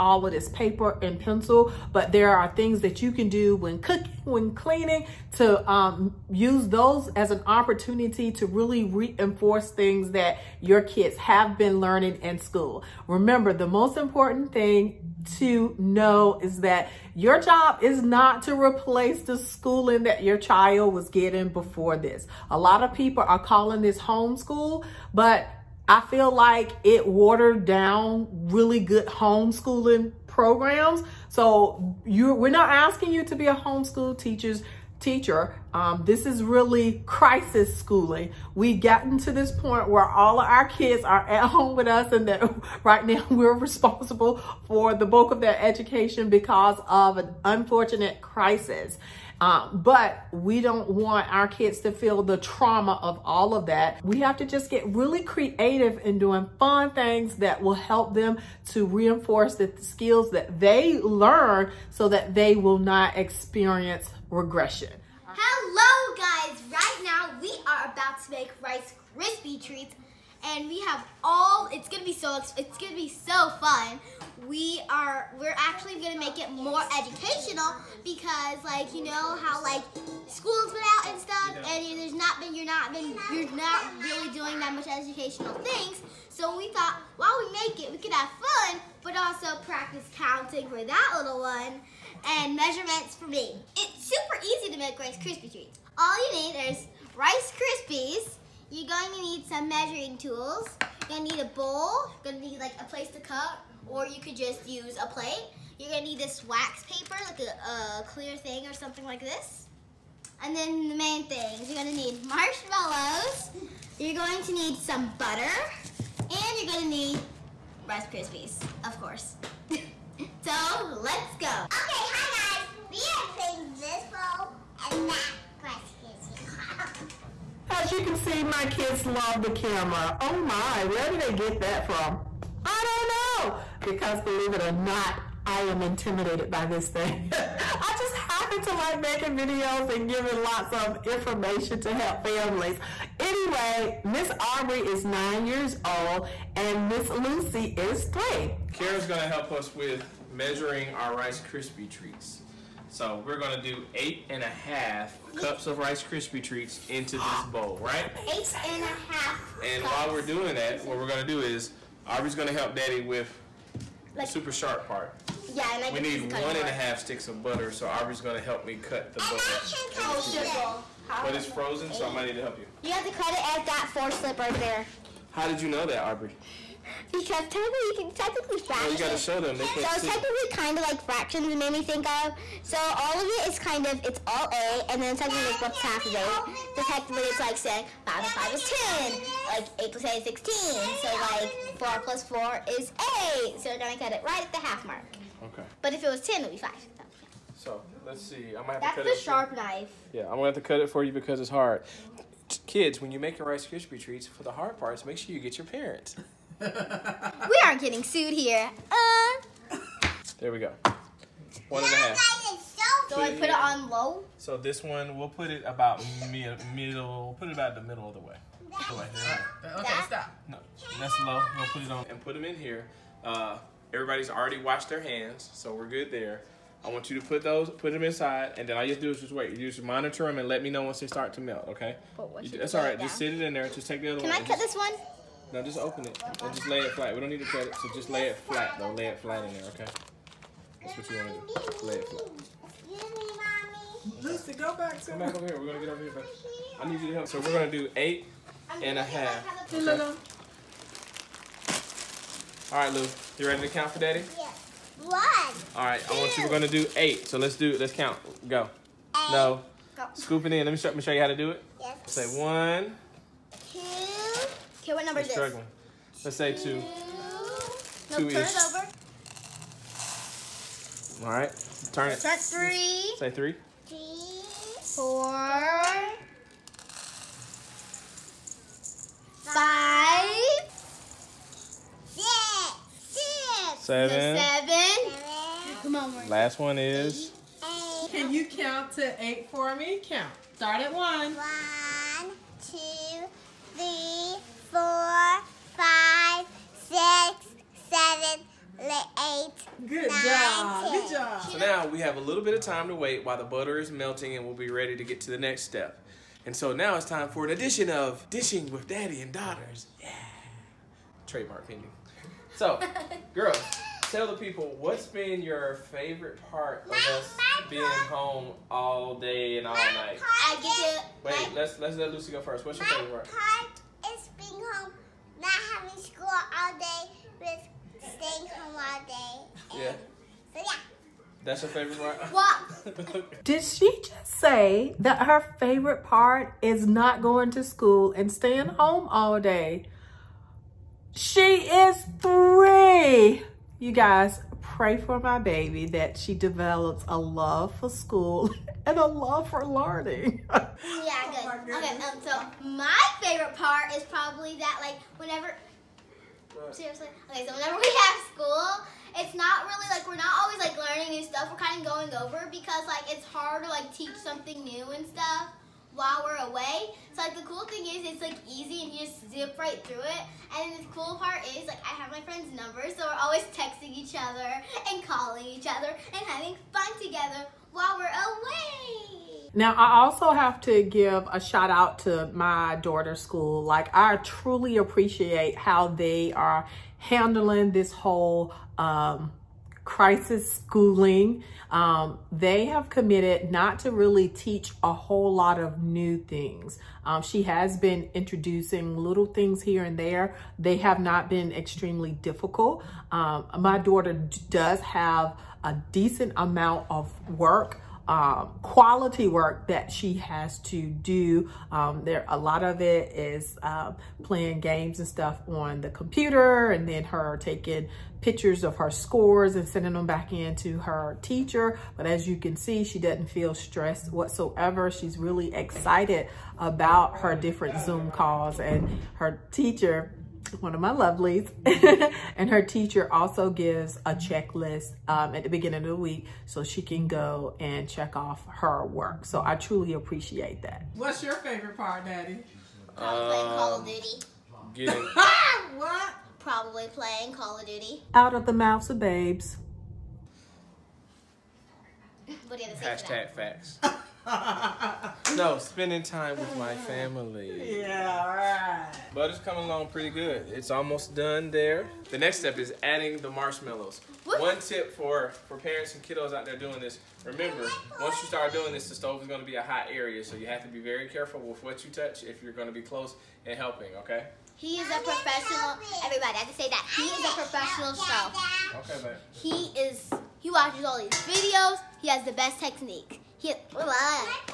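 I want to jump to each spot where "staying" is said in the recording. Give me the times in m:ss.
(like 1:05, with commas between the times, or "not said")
5:28, 5:38.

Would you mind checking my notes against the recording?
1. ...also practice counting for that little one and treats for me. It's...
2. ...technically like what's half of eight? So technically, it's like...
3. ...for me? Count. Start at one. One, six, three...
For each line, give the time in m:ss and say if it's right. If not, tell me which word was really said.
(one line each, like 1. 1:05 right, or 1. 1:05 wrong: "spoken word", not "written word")
1. 1:29 wrong: "measurements", not "treats"
2. 3:05 right
3. 4:49 wrong: "two", not "six".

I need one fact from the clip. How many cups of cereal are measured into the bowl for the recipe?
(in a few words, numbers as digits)
8.5.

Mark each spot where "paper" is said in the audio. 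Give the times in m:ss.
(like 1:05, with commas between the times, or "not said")
0:00, 1:46.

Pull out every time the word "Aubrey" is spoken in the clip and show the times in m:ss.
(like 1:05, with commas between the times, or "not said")
2:24, 2:42, 2:47.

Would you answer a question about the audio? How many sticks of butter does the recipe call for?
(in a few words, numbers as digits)
1.5.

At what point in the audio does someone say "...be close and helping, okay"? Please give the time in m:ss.
7:52.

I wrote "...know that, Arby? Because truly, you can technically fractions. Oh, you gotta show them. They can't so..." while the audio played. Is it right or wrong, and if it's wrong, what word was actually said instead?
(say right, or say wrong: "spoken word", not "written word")
wrong: "technically", not "truly".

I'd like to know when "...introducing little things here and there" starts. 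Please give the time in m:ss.
6:38.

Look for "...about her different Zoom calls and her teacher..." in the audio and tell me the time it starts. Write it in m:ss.
7:06.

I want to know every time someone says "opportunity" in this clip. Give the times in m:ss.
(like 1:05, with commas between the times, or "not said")
0:07.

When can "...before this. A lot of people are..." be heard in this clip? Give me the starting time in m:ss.
0:21.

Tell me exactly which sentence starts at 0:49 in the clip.
Um, but we don't want our kids to feel the trauma of all of that.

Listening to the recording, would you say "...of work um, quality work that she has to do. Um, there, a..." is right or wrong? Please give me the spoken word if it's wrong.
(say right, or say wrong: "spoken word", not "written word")
right.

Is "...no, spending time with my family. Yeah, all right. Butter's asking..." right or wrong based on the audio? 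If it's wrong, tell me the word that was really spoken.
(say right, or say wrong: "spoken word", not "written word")
wrong: "coming", not "asking".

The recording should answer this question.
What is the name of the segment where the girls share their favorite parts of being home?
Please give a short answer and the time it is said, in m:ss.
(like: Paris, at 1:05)
Dishing with Daddy and Daughters, at 5:08.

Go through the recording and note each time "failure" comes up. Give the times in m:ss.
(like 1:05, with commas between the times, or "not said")
not said.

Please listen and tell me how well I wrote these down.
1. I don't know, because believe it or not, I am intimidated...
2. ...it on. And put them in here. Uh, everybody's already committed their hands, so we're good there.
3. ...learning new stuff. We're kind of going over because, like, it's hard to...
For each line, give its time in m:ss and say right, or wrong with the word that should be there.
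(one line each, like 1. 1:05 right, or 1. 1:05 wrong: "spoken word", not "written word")
1. 2:12 right
2. 3:41 wrong: "washed", not "committed"
3. 6:00 right.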